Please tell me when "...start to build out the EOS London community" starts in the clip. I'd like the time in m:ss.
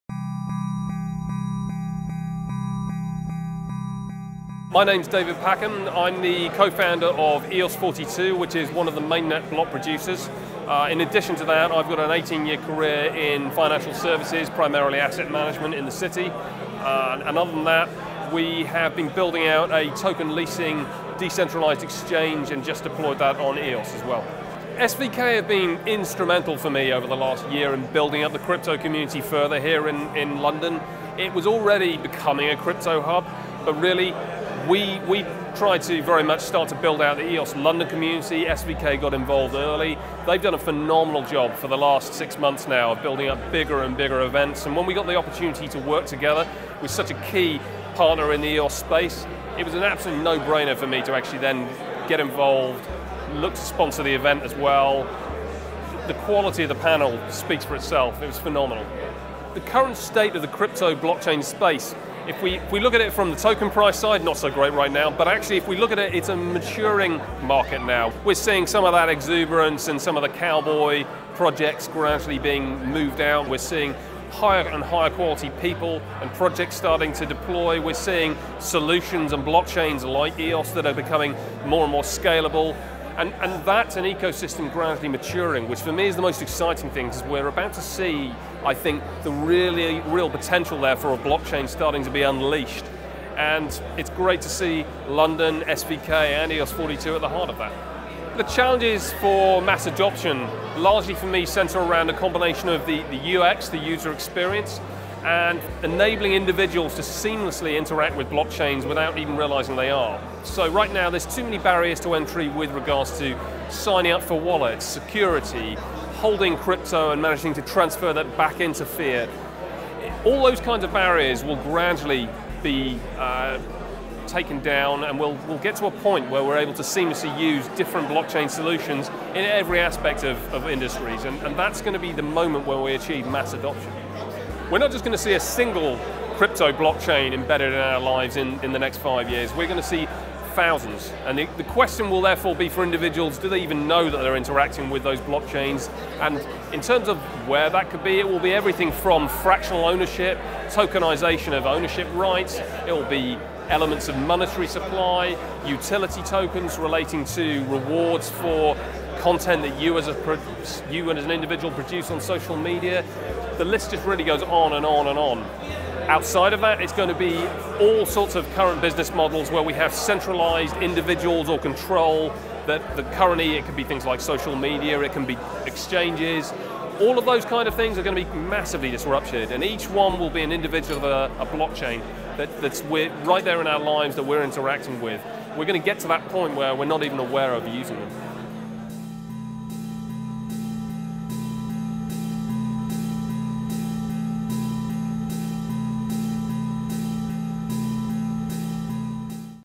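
0:36.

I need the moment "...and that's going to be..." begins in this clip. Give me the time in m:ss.
2:11.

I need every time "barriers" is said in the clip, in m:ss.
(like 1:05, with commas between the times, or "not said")
1:51, 2:00.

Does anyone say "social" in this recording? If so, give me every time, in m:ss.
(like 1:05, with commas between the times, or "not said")
2:42, 2:54.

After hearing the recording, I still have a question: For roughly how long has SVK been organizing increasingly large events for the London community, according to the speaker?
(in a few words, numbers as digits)
six months.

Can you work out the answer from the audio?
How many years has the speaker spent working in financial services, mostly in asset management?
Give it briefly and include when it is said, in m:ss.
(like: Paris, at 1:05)
18, at 0:12.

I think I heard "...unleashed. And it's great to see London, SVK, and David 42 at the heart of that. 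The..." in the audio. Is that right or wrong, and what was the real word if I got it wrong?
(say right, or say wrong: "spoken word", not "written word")
wrong: "EOS", not "David".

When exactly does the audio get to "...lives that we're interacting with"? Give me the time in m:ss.
3:03.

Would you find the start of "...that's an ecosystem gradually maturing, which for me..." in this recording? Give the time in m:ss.
1:23.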